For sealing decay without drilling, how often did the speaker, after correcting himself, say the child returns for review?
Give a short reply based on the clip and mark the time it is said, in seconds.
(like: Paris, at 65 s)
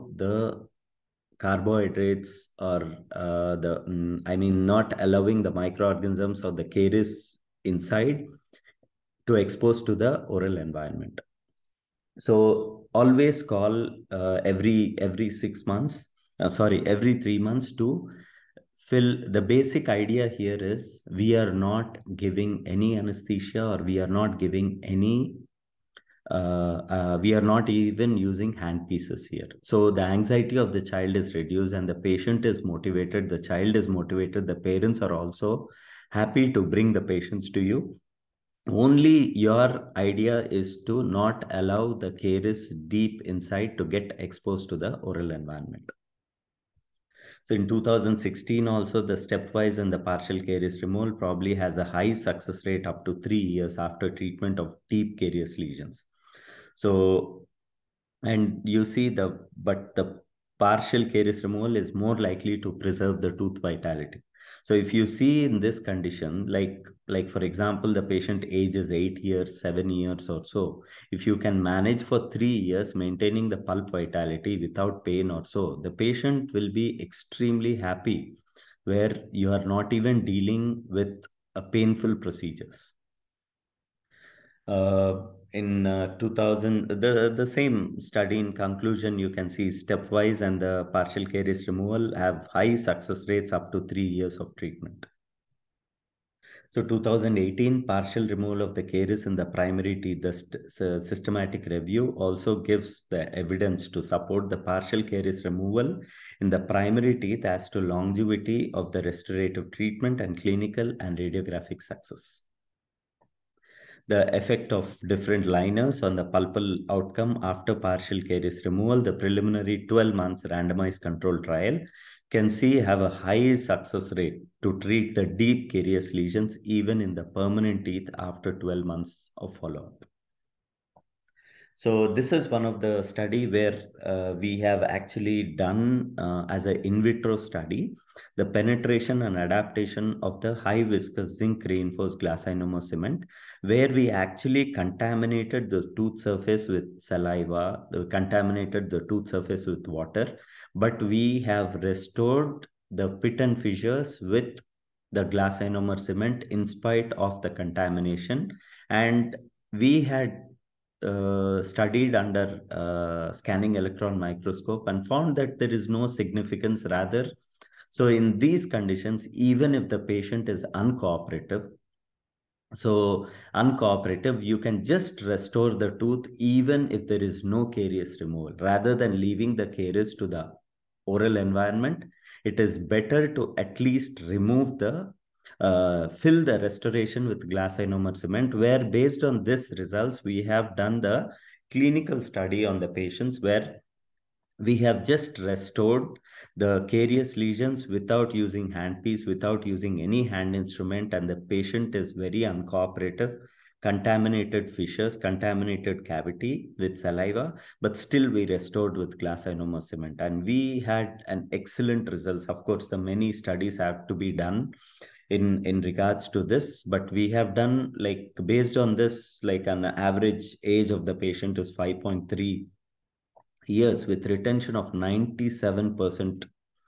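every 3 months, at 16 s.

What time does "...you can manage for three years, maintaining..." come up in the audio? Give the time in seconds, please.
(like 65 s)
71 s.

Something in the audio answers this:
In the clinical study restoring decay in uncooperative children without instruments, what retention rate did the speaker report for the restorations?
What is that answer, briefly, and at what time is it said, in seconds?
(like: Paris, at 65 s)
97%, at 224 s.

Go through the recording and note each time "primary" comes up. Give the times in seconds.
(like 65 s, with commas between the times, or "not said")
99 s, 106 s.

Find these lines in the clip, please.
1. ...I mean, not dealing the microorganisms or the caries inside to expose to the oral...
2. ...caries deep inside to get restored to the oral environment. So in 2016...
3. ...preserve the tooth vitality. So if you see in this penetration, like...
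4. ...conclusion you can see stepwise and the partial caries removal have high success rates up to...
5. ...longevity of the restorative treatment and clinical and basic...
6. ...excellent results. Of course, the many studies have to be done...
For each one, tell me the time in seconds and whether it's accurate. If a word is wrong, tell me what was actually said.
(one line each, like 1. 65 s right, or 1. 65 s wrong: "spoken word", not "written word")
1. 4 s wrong: "allowing", not "dealing"
2. 42 s wrong: "exposed", not "restored"
3. 62 s wrong: "condition", not "penetration"
4. 88 s right
5. 107 s wrong: "radiographic", not "basic"
6. 211 s right.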